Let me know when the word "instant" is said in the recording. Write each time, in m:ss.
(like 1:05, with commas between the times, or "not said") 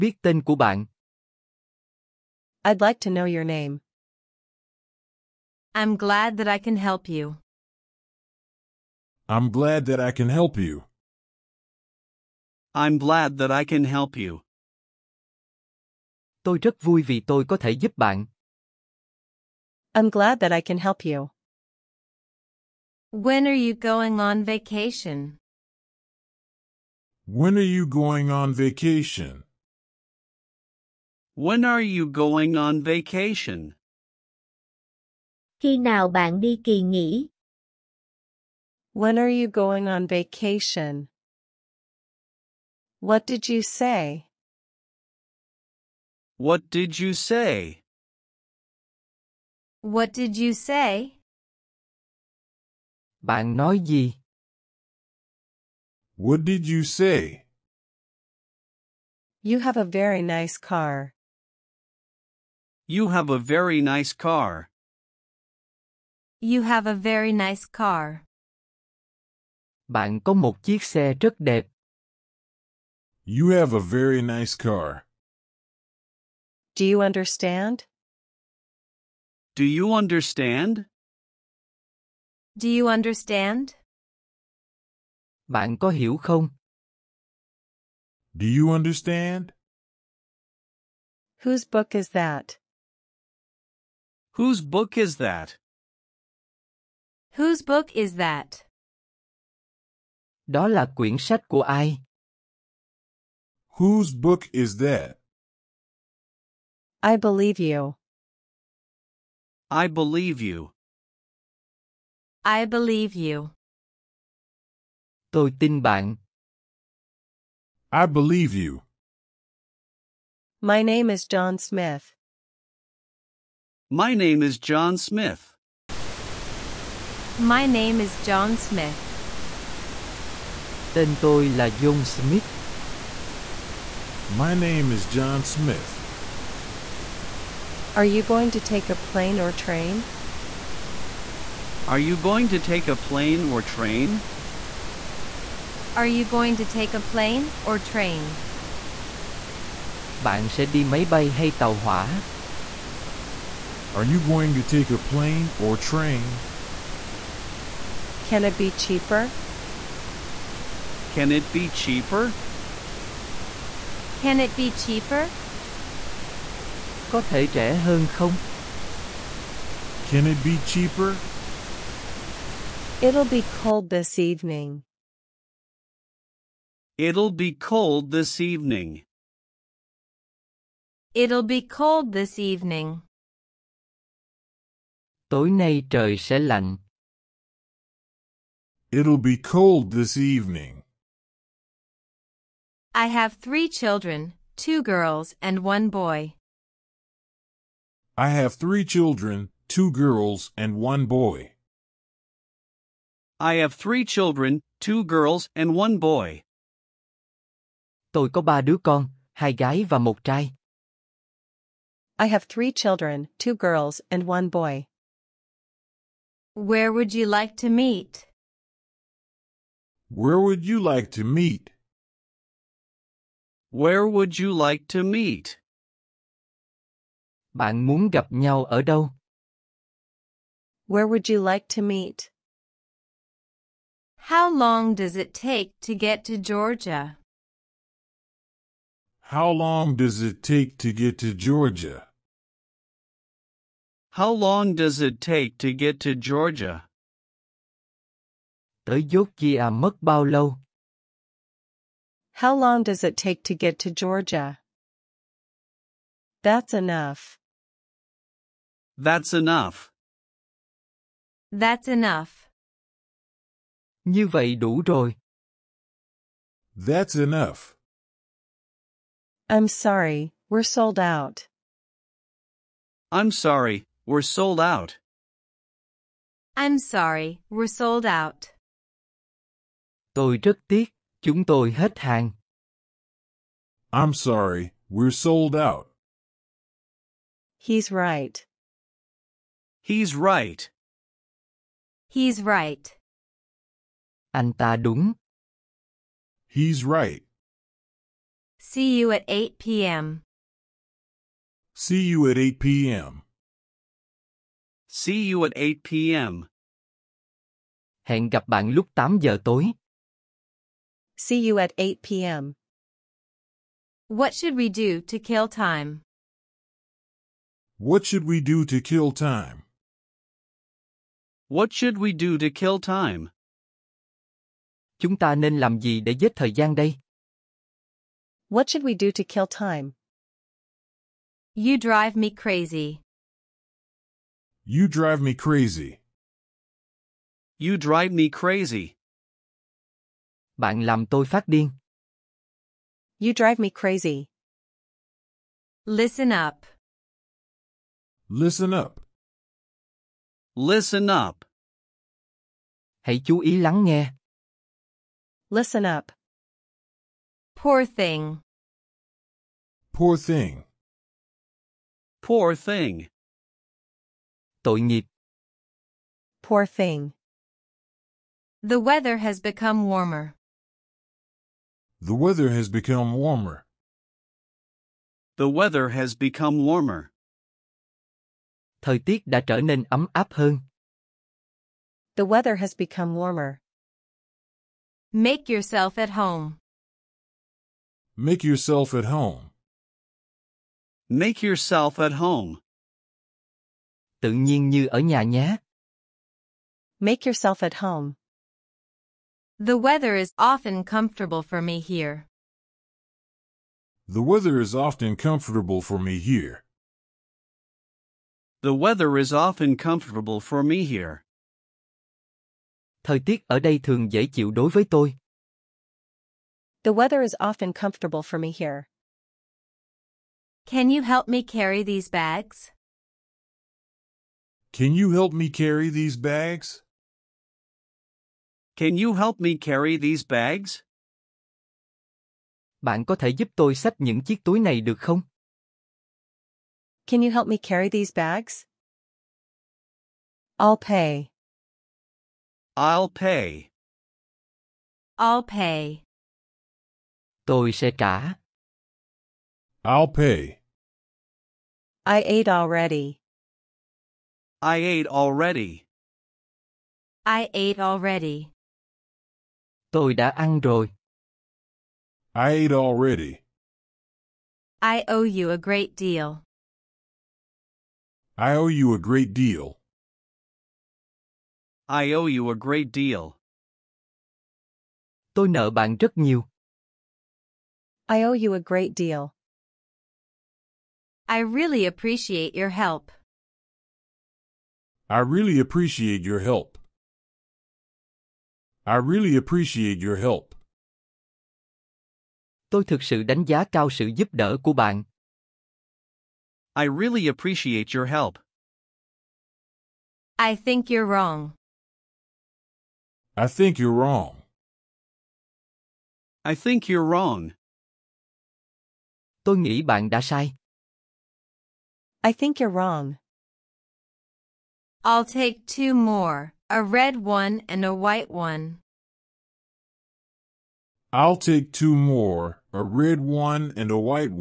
not said.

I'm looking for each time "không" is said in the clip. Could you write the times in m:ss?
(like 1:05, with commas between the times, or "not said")
1:26, 2:48, 7:14.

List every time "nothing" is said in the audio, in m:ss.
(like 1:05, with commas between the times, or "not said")
not said.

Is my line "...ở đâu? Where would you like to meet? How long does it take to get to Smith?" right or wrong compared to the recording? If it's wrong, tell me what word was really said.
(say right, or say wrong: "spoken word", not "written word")
wrong: "Georgia", not "Smith".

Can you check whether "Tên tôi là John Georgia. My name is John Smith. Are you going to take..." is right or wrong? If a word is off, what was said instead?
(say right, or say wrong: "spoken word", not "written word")
wrong: "Smith", not "Georgia".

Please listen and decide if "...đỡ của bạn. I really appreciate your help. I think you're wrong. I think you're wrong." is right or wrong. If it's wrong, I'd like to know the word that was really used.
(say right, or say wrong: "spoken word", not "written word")
right.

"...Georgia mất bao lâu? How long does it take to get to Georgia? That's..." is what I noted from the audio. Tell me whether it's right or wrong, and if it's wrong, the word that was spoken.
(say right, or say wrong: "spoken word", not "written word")
right.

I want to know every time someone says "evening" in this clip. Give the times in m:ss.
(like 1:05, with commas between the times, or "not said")
2:54, 2:58, 3:02, 3:10.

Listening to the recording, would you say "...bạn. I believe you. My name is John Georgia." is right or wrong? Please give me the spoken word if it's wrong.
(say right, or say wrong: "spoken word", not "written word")
wrong: "Smith", not "Georgia".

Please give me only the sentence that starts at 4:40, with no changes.
Tôi rất tiếc, chúng tôi hết hàng.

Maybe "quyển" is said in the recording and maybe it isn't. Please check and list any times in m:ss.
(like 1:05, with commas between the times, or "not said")
1:40.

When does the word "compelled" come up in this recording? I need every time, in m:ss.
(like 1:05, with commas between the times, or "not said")
not said.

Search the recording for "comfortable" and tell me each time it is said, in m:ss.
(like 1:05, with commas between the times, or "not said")
6:40, 6:45, 6:49, 6:57.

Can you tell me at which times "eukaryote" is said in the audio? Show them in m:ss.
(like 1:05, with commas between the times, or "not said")
not said.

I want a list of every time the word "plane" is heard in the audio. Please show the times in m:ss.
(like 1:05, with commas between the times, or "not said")
2:18, 2:22, 2:26, 2:34.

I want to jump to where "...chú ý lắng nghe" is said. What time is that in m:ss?
5:53.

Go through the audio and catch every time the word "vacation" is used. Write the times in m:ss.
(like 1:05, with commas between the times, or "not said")
0:24, 0:28, 0:32, 0:40.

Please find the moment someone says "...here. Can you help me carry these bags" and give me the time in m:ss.
6:58.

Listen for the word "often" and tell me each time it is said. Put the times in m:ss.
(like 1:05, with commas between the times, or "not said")
6:40, 6:44, 6:49, 6:57.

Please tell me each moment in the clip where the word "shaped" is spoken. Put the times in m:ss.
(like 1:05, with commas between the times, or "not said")
not said.